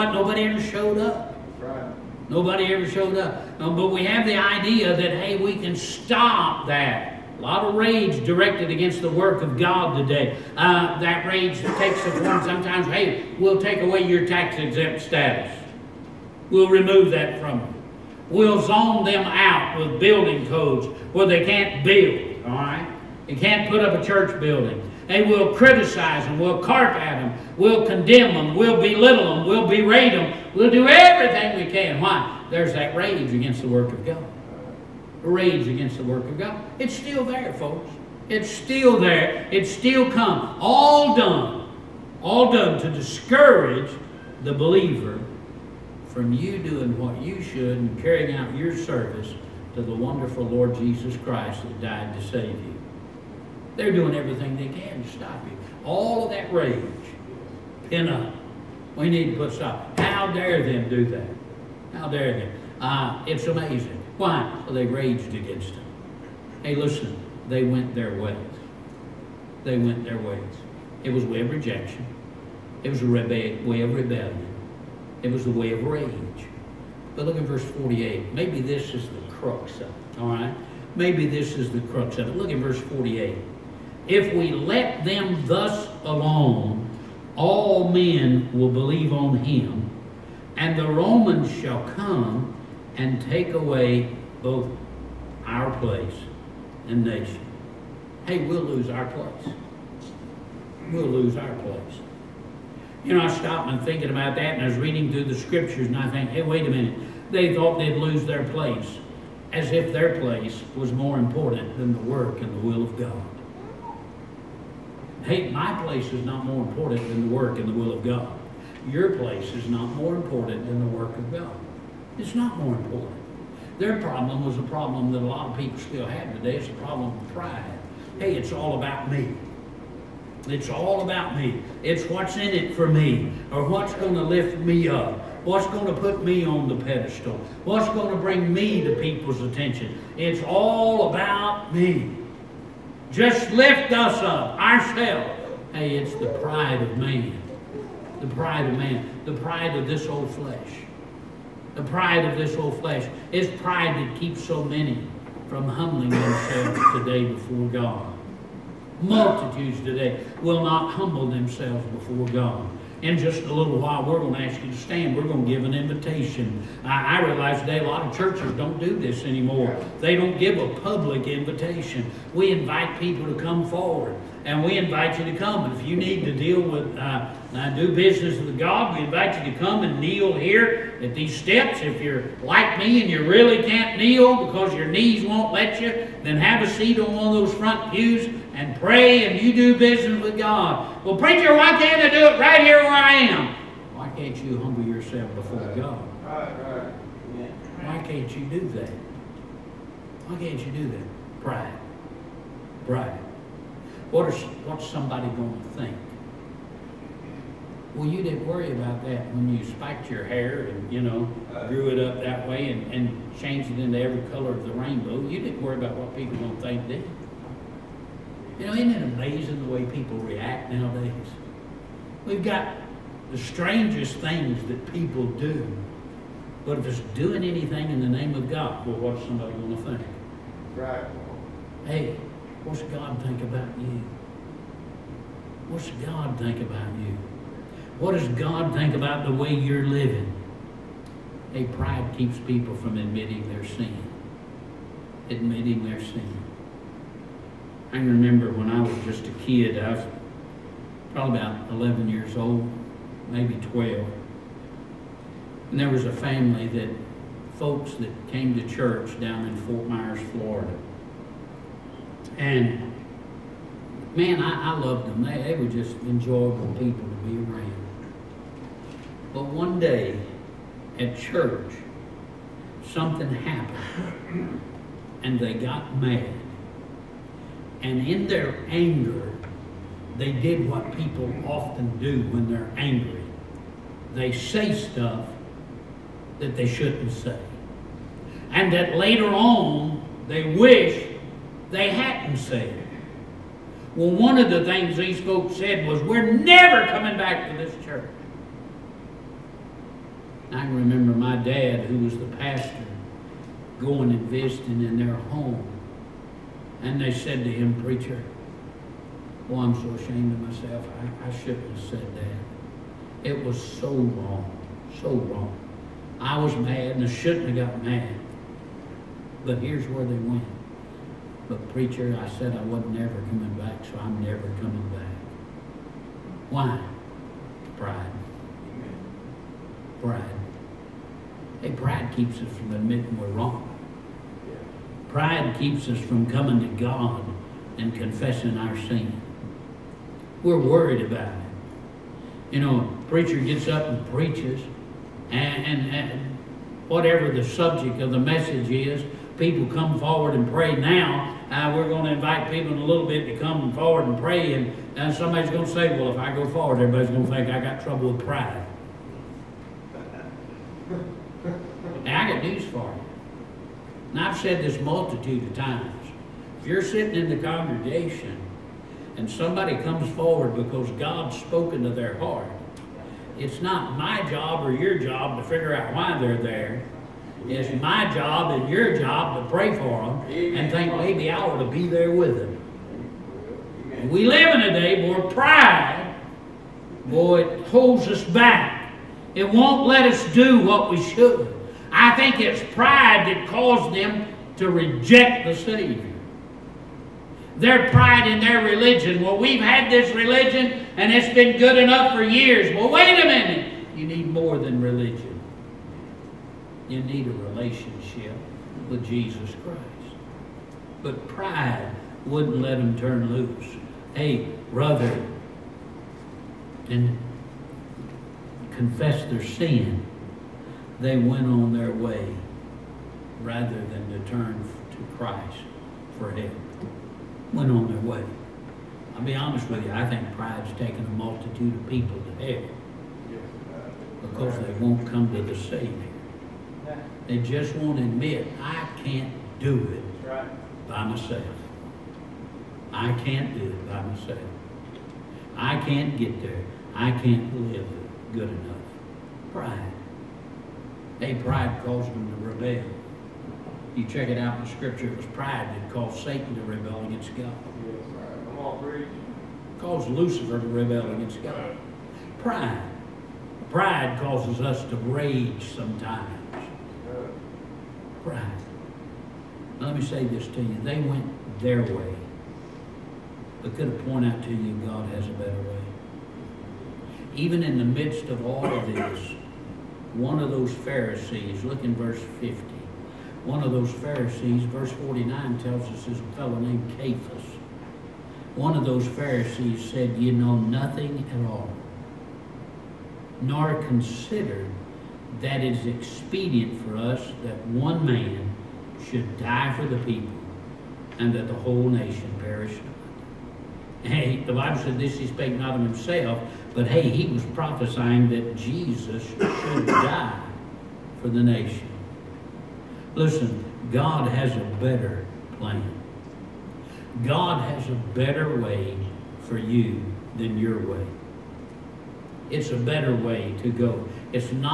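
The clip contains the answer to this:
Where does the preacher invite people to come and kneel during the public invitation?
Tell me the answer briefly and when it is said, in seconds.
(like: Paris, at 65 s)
At these steps, at 179 s.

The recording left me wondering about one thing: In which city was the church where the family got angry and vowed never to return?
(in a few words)
Fort Myers, Florida.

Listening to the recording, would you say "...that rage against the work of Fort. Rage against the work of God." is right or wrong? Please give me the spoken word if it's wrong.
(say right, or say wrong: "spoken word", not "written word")
wrong: "God", not "Fort".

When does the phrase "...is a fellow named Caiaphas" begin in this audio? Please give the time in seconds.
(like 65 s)
486 s.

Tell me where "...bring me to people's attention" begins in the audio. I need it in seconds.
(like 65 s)
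138 s.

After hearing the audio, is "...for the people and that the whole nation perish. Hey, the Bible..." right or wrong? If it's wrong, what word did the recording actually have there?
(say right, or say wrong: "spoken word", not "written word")
right.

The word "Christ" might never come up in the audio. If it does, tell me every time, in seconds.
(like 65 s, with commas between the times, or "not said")
51 s, 409 s, 425 s.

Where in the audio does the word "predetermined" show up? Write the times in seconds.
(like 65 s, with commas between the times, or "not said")
not said.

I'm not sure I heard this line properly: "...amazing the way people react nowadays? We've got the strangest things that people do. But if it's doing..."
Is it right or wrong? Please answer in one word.
right.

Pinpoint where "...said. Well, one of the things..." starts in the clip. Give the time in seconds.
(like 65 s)
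292 s.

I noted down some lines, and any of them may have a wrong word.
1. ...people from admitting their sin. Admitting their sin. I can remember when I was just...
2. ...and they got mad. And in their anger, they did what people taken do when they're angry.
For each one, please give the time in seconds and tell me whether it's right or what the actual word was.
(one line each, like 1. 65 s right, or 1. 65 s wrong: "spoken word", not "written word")
1. 242 s right
2. 275 s wrong: "often", not "taken".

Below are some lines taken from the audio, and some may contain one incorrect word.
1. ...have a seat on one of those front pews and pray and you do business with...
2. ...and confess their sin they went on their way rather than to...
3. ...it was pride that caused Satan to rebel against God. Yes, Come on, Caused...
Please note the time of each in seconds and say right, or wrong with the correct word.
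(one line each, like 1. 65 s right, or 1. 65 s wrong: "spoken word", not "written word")
1. 186 s right
2. 416 s right
3. 455 s right.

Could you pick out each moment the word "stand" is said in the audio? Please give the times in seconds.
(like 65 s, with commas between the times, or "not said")
164 s.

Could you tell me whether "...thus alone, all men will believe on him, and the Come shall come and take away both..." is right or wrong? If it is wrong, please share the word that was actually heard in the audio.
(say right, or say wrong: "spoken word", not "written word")
wrong: "Romans", not "Come".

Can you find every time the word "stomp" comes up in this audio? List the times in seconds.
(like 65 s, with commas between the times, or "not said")
not said.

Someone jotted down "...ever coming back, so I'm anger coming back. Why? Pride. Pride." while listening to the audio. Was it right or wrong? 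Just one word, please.
wrong.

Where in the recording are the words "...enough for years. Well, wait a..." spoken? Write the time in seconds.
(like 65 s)
401 s.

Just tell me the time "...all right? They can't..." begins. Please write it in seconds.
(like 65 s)
22 s.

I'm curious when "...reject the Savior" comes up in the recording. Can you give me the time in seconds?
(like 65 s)
394 s.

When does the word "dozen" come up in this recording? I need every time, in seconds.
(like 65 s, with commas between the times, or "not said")
not said.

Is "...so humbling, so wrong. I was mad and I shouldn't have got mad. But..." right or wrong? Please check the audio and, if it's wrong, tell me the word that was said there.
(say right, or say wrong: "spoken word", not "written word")
wrong: "wrong", not "humbling".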